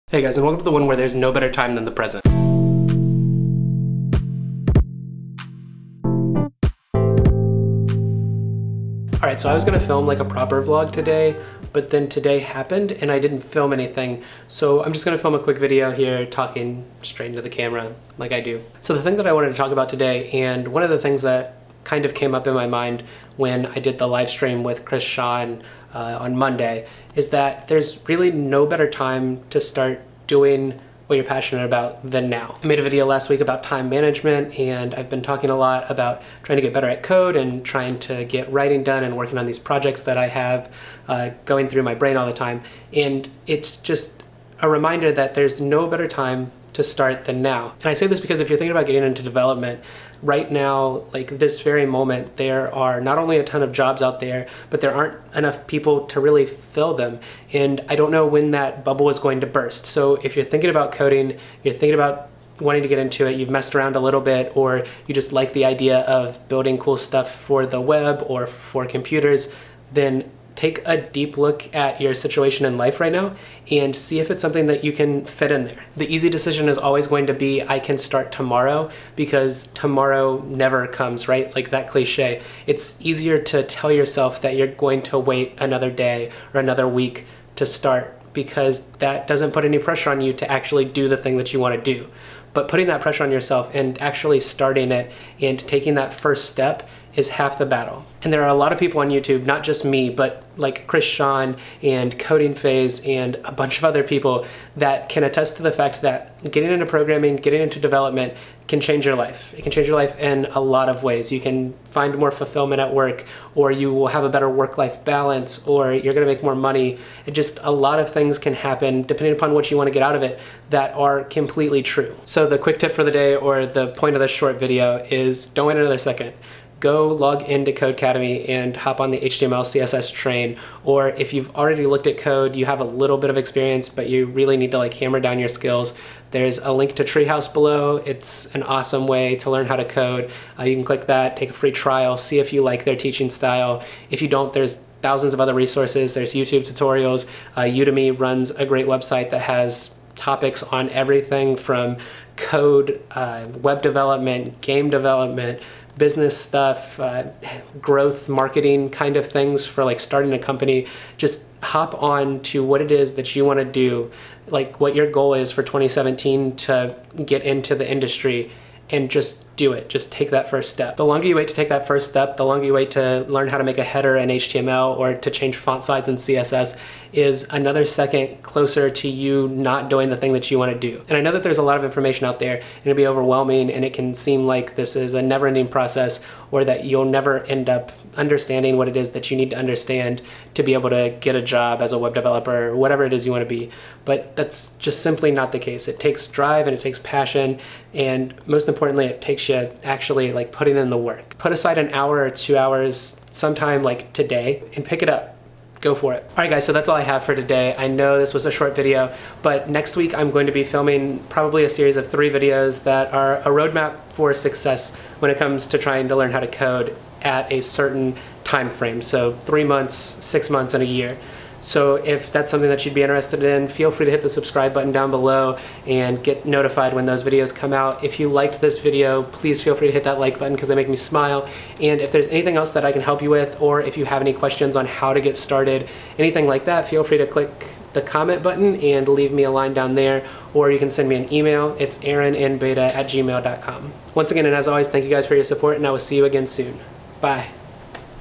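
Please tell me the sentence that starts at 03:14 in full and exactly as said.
But that's just simply not the case.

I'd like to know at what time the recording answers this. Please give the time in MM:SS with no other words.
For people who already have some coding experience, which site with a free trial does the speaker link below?
02:17.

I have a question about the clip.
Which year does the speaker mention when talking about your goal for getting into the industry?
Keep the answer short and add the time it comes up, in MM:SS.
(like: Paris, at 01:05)
2017, at 02:45.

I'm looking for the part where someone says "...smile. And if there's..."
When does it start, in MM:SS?
03:50.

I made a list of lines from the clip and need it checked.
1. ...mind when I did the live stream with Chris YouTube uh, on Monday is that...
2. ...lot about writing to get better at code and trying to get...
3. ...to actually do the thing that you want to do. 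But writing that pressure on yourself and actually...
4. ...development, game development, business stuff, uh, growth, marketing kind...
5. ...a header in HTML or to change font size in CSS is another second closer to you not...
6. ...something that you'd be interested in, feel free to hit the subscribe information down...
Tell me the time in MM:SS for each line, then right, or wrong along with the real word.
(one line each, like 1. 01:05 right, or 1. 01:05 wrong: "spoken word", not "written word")
1. 00:22 wrong: "Sean", not "YouTube"
2. 00:35 wrong: "trying", not "writing"
3. 01:30 wrong: "putting", not "writing"
4. 02:33 right
5. 02:53 right
6. 03:42 wrong: "button", not "information".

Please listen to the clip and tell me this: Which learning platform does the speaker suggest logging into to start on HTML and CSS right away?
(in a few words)
Codecademy.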